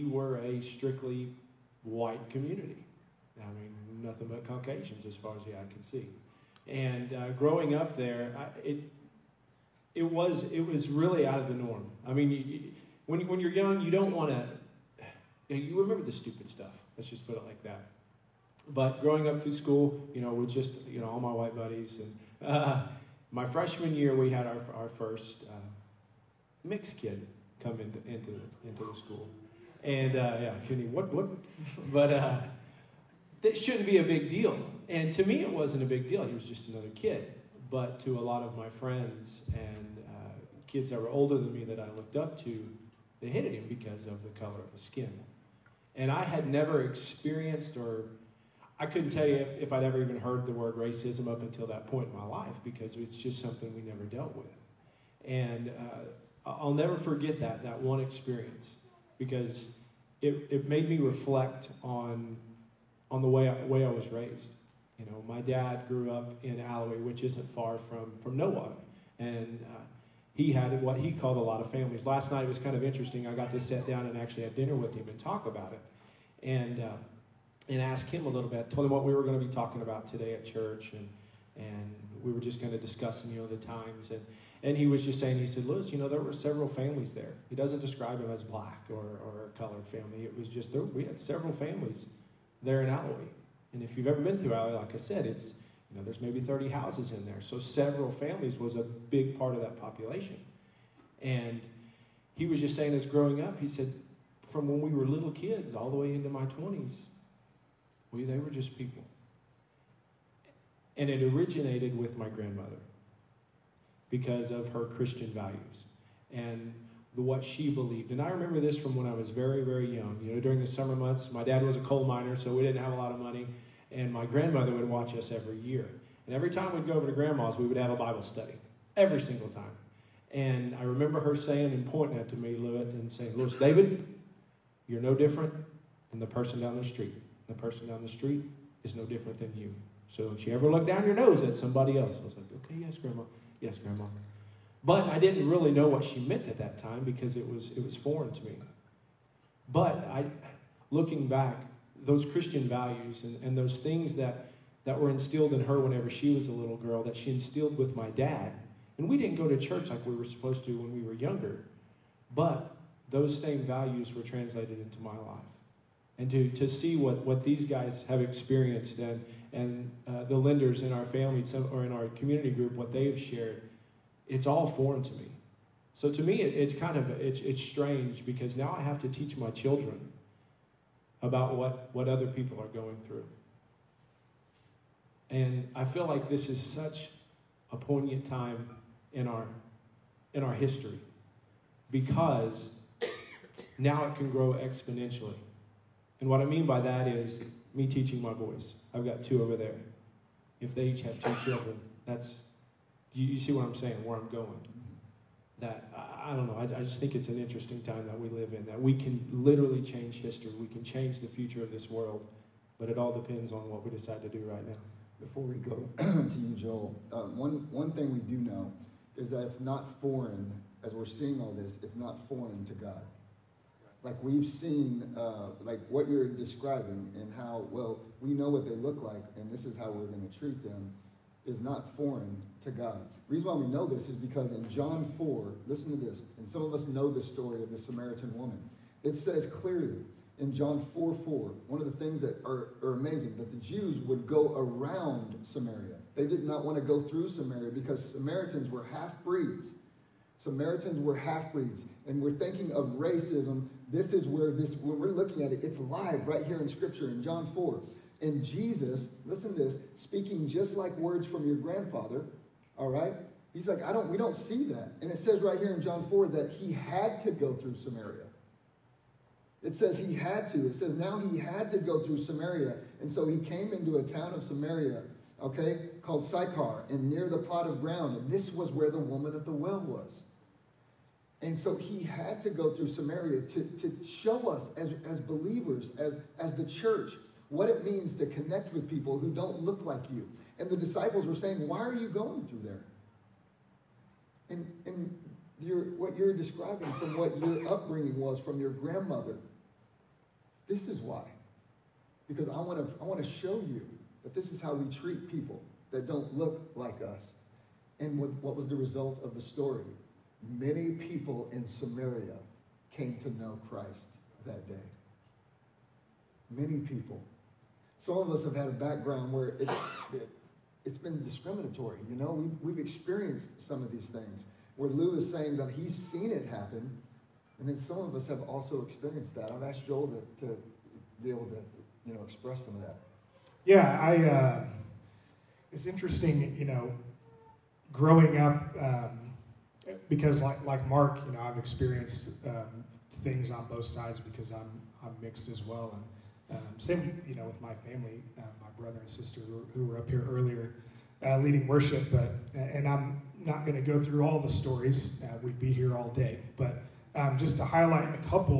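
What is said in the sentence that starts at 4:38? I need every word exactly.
And this was where the woman at the well was.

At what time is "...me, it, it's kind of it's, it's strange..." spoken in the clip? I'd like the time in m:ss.
2:56.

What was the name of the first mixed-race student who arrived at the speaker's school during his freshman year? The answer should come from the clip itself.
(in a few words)
Kenny.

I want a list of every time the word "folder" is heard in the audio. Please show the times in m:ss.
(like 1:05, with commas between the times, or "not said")
not said.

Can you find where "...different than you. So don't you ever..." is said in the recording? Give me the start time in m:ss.
2:19.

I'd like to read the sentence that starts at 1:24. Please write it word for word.
And, and he was just saying, he said, Lewis, you know, there were several families there.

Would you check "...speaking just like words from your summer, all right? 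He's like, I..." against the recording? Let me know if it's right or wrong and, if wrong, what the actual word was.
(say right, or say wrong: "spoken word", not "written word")
wrong: "grandfather", not "summer".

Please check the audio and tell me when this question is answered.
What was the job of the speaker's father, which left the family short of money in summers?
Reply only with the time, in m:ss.
2:01.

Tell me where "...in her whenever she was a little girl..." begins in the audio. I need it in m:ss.
2:35.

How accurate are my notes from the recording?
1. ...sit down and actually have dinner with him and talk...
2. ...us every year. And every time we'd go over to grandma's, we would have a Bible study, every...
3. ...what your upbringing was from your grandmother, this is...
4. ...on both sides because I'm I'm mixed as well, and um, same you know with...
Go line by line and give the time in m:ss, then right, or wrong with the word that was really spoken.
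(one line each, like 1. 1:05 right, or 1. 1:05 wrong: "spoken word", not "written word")
1. 1:13 right
2. 2:05 right
3. 4:57 right
4. 5:43 right.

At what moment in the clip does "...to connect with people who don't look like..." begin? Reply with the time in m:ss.
4:48.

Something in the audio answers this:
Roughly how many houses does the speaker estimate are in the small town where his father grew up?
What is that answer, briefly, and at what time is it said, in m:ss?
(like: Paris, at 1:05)
30, at 1:36.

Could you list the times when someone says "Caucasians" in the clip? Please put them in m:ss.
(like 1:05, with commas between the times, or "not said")
0:04.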